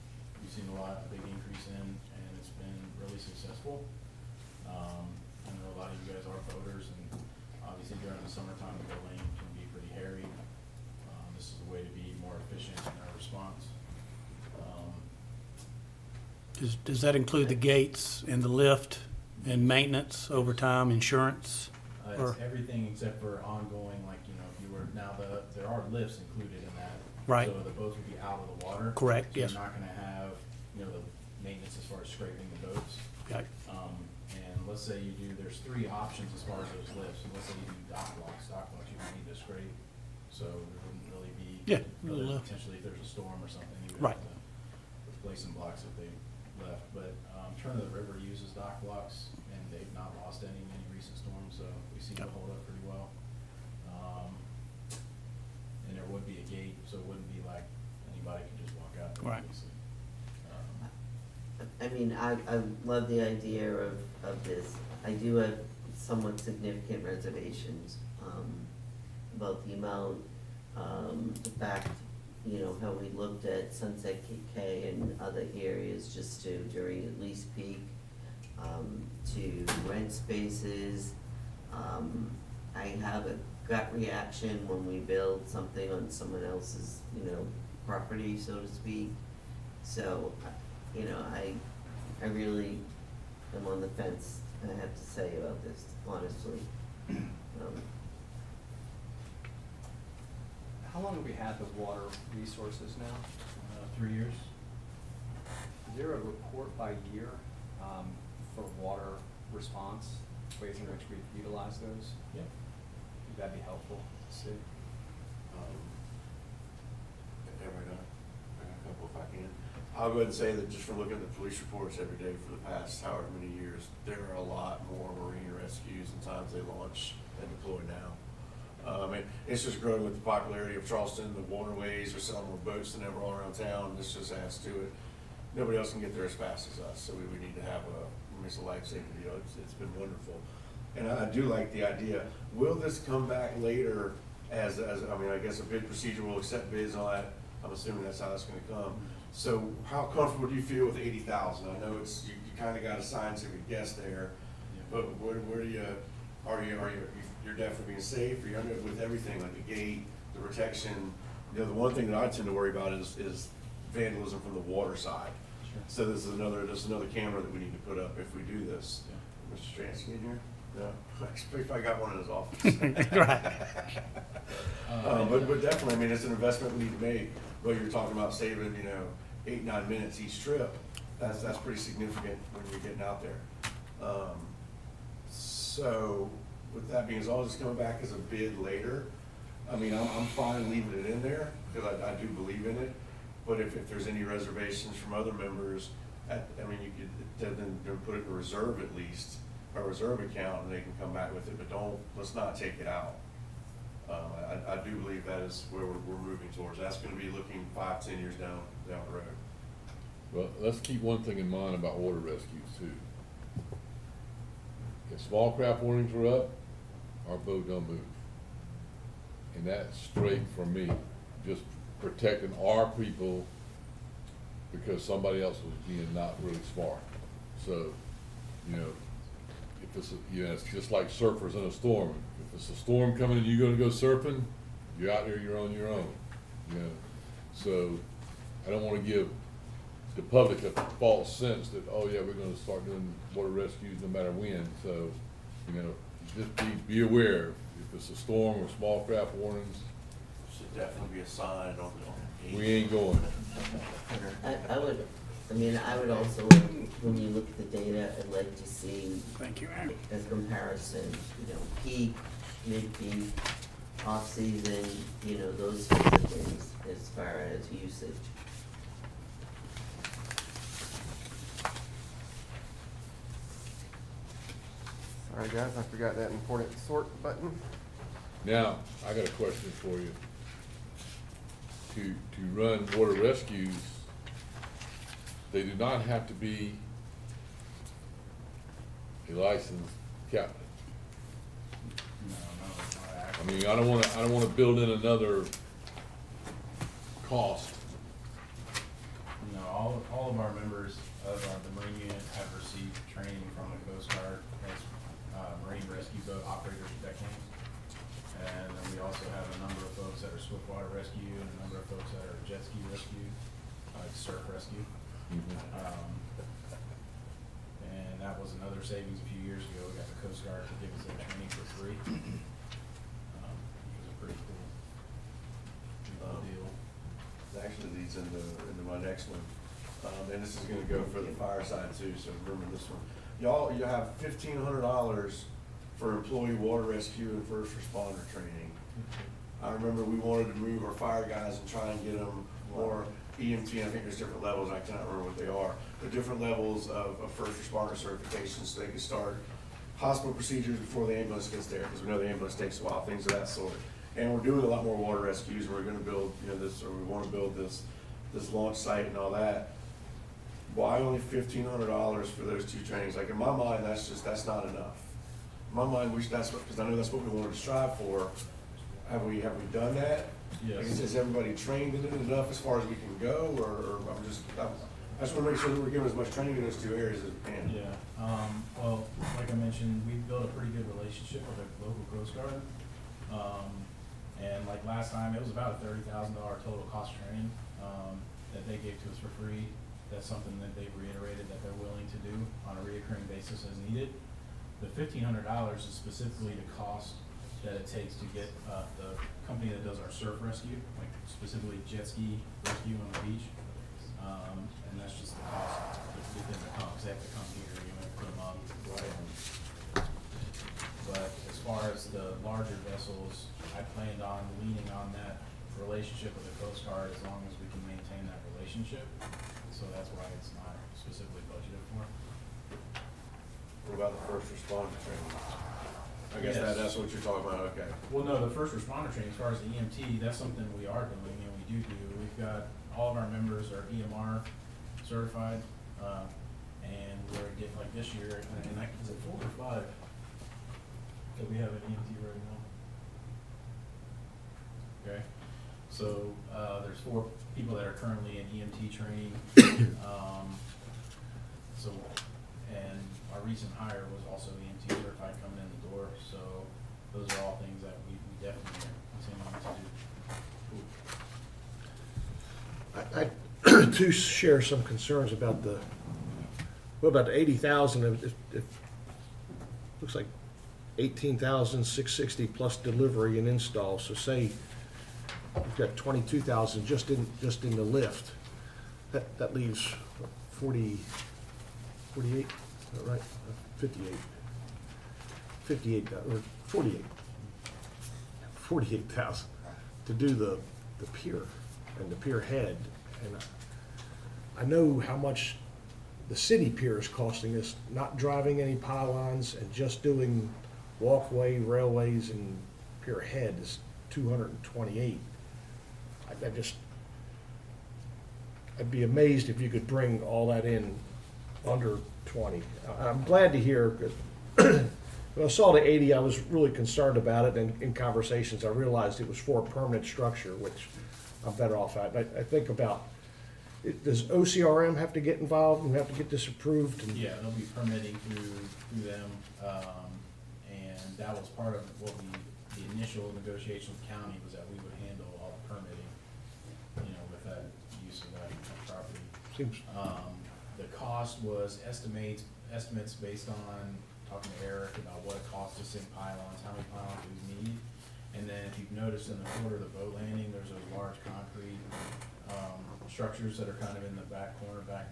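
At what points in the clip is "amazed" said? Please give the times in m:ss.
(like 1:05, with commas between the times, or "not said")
8:29.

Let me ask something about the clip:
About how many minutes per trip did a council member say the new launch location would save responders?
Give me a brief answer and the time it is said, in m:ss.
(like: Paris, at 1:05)
8 or 9 minutes, at 2:59.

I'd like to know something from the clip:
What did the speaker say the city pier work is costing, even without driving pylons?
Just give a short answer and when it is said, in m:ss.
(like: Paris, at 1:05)
$228,000, at 8:24.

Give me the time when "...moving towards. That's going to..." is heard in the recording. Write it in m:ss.
3:26.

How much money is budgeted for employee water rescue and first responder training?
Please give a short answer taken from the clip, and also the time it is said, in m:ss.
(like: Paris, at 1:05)
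$1,500, at 5:34.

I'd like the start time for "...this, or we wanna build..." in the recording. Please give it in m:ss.
5:56.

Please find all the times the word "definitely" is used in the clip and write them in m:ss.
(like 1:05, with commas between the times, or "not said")
2:37, 2:55, 4:10, 7:38.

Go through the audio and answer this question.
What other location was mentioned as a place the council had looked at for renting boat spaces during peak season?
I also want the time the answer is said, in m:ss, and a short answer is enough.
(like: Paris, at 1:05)
Sunset Cay, at 1:13.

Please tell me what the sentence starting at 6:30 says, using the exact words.
That's something that they've reiterated that they're willing to do on a reoccurring basis as needed.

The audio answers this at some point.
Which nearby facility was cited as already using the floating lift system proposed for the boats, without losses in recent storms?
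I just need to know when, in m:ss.
0:47.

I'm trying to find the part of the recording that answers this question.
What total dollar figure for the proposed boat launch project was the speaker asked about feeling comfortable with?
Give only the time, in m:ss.
2:30.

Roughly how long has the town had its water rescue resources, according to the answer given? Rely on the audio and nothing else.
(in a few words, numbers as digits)
3 years.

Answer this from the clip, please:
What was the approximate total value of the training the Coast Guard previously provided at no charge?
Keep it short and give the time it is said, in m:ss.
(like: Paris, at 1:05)
$30,000, at 6:25.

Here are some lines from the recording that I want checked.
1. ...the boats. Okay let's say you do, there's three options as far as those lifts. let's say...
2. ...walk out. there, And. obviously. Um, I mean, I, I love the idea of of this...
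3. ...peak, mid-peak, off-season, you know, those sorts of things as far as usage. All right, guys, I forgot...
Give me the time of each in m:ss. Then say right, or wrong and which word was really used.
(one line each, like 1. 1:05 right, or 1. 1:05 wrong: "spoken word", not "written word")
1. 0:32 right
2. 0:58 wrong: "Right", not "And"
3. 4:21 right.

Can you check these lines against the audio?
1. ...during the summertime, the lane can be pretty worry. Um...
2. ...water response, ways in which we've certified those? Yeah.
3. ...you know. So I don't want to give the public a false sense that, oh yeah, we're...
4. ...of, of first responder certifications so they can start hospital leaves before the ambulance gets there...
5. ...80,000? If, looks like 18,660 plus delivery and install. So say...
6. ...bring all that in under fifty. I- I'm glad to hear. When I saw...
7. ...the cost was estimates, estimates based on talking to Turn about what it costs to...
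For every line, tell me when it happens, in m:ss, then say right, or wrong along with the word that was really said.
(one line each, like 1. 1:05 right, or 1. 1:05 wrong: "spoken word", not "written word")
1. 0:08 wrong: "hairy", not "worry"
2. 1:48 wrong: "utilized", not "certified"
3. 3:56 right
4. 5:46 wrong: "procedures", not "leaves"
5. 7:47 right
6. 8:29 wrong: "twenty", not "fifty"
7. 9:00 wrong: "Eric", not "Turn".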